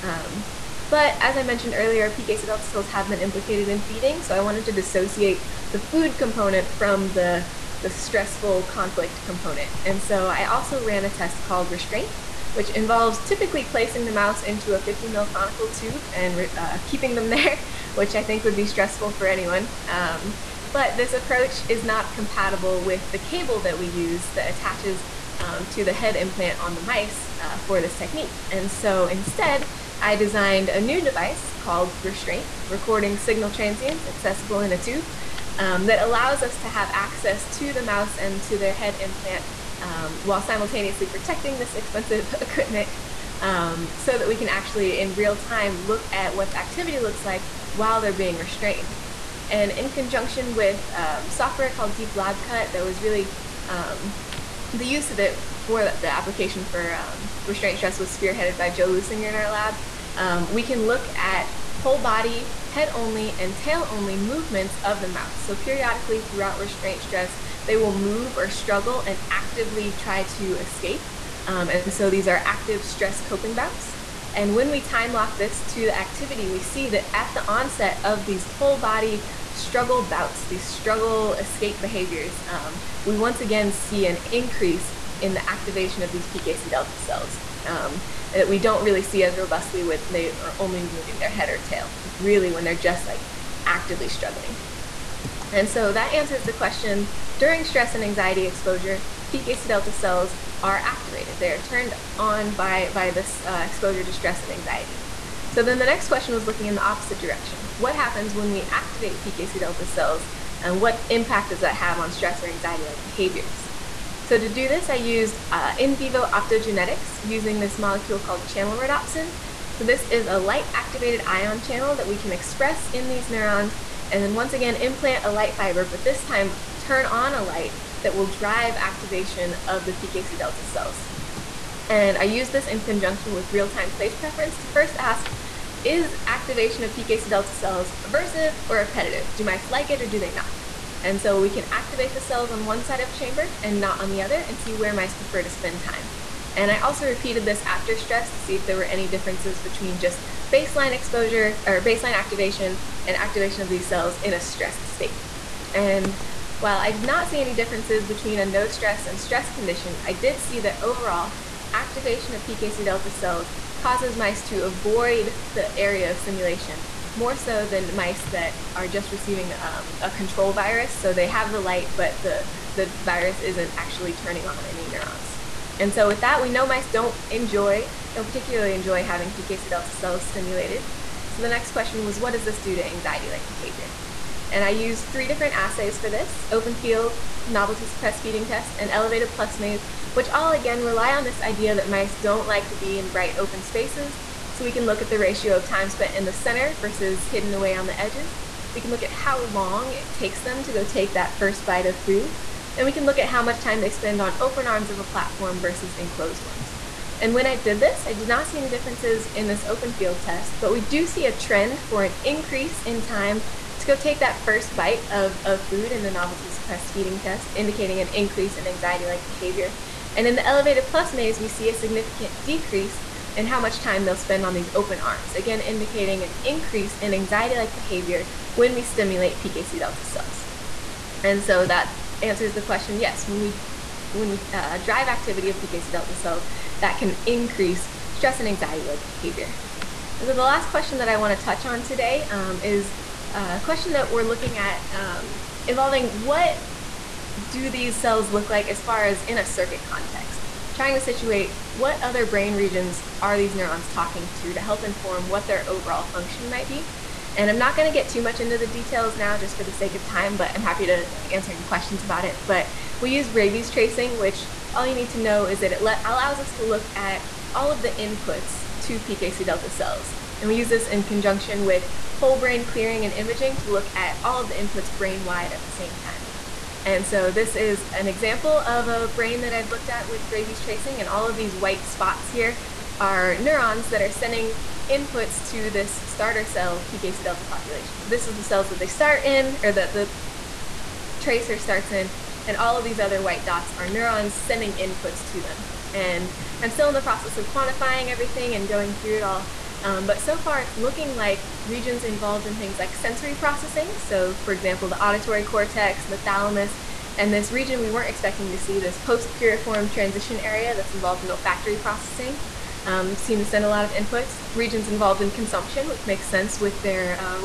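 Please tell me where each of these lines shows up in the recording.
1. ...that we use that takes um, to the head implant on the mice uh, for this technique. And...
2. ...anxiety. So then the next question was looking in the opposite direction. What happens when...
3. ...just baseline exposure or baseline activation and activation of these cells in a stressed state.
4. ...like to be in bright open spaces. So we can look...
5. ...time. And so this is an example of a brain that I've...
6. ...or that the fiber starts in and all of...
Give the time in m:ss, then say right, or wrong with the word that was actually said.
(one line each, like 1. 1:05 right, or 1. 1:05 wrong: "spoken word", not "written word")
1. 0:23 wrong: "attaches", not "takes"
2. 1:44 right
3. 2:29 right
4. 3:12 right
5. 4:36 right
6. 4:49 wrong: "tracer", not "fiber".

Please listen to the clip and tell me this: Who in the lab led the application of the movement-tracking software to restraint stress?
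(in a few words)
Joe Lusinger.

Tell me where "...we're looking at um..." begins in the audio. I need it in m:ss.
4:04.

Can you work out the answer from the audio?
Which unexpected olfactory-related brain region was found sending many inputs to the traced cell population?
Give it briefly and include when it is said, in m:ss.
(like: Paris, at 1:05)
post piriform transition area, at 5:08.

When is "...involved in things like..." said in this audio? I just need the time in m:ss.
5:02.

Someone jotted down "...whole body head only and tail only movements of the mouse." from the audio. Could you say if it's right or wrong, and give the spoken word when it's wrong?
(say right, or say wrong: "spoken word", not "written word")
right.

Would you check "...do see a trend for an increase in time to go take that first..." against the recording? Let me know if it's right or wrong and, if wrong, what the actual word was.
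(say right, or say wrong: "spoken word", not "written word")
right.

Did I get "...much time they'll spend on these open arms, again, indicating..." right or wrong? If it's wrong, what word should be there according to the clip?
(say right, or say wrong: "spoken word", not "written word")
right.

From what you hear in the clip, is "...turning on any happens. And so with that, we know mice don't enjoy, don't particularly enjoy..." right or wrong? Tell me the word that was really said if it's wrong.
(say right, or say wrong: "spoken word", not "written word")
wrong: "neurons", not "happens".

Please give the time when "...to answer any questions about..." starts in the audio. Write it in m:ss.
4:20.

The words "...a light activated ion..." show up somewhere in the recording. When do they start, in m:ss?
2:00.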